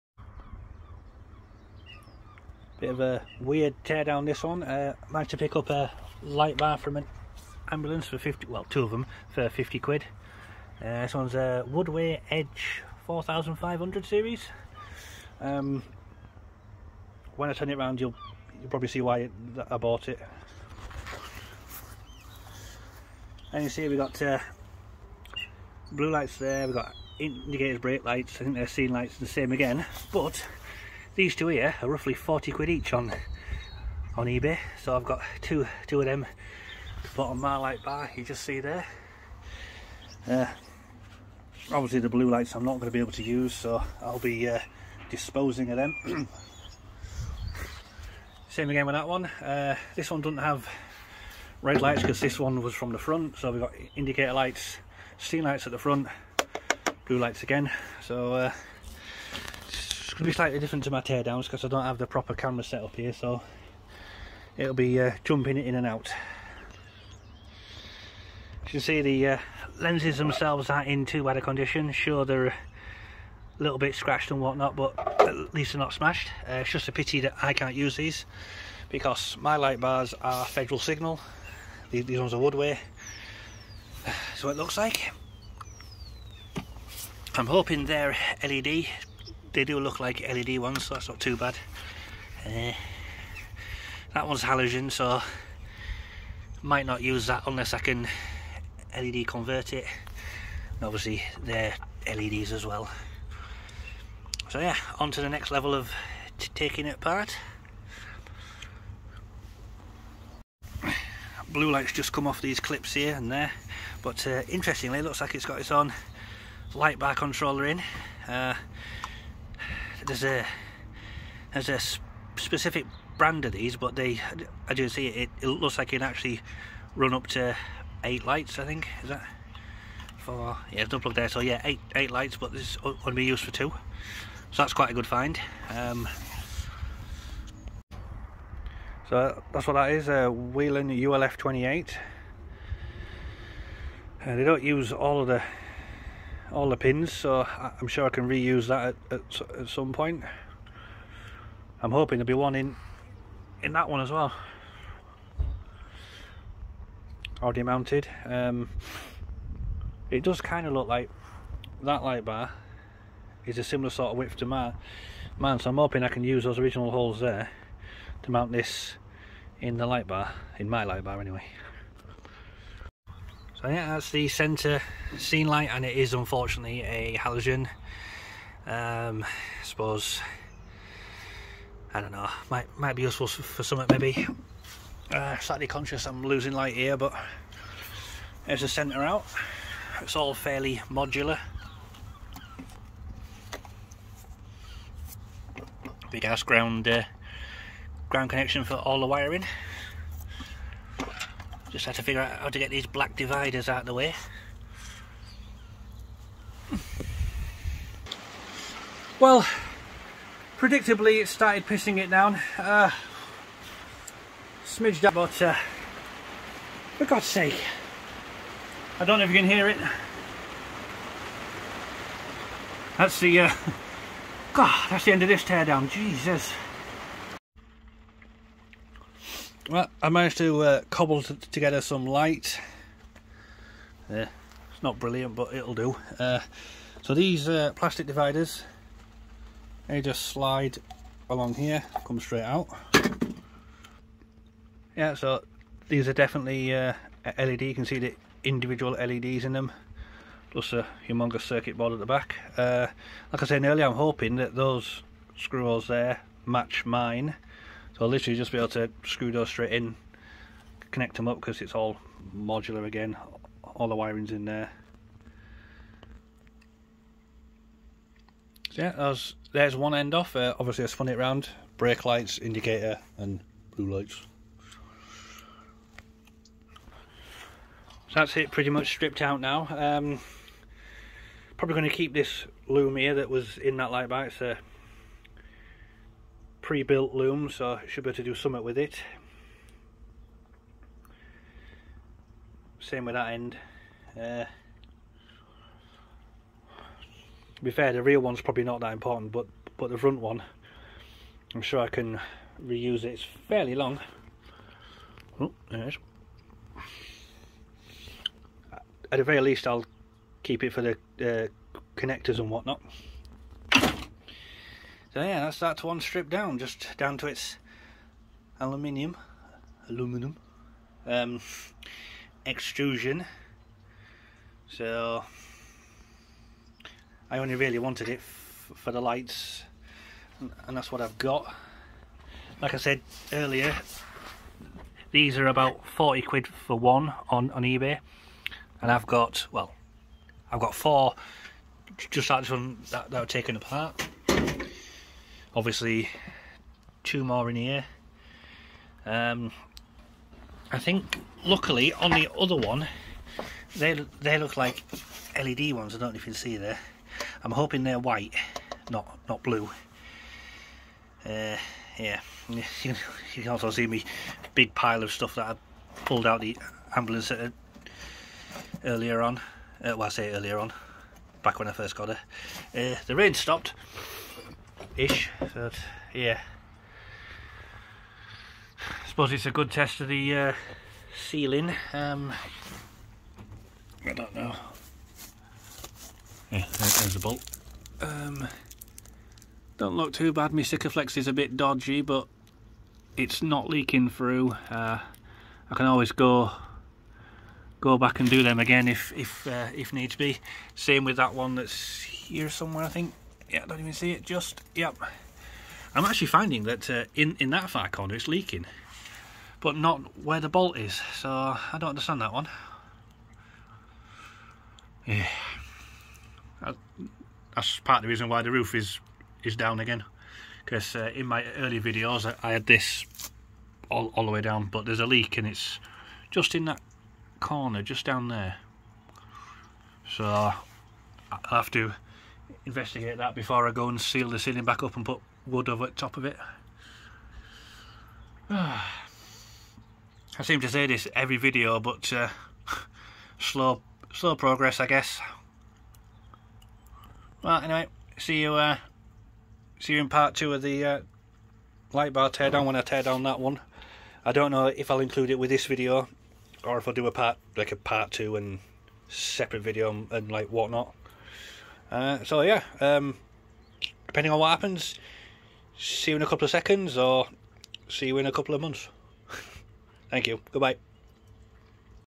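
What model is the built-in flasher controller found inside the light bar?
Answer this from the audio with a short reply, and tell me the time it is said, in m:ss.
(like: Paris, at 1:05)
Whelen ULF 28, at 2:20.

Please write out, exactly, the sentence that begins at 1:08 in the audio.
As you can see the uh, lenses themselves are in too bad a condition.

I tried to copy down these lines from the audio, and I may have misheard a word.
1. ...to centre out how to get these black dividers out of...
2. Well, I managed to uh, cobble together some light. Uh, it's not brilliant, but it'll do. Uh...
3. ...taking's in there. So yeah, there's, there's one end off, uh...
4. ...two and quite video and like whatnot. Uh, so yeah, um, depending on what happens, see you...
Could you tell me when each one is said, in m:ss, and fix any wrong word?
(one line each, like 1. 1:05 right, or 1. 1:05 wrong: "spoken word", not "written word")
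1. 3:21 wrong: "figure", not "centre"
2. 3:49 right
3. 4:23 wrong: "wiring", not "taking"
4. 7:38 wrong: "separate", not "quite".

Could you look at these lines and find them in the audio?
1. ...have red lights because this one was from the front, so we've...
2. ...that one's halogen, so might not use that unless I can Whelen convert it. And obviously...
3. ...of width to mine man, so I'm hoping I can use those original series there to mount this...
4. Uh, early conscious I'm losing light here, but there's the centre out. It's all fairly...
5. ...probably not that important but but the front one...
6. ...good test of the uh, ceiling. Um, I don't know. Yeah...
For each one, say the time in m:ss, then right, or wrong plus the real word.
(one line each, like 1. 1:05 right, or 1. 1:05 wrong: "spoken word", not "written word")
1. 0:50 right
2. 1:34 wrong: "LED", not "Whelen"
3. 2:44 wrong: "holes", not "series"
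4. 3:05 wrong: "slightly", not "early"
5. 4:58 right
6. 6:19 right.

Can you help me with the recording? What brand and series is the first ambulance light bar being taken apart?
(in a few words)
Woodway Edge 4500.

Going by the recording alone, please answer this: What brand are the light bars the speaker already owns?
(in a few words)
Federal Signal.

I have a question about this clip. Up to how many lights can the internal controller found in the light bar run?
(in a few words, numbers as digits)
8.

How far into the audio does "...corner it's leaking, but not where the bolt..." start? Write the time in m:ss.
6:47.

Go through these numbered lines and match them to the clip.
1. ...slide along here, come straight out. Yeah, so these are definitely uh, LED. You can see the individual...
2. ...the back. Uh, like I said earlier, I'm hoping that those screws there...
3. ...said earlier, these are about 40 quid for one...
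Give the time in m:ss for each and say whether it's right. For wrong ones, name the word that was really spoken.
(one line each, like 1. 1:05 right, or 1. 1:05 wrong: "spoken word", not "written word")
1. 4:00 right
2. 4:11 right
3. 5:32 right.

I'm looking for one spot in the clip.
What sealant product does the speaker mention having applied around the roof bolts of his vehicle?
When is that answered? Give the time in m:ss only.
6:30.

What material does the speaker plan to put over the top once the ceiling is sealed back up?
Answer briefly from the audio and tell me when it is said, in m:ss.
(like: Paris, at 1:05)
Wood, at 7:15.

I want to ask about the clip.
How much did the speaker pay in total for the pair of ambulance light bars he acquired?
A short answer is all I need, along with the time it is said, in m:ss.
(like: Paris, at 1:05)
50 quid, at 0:08.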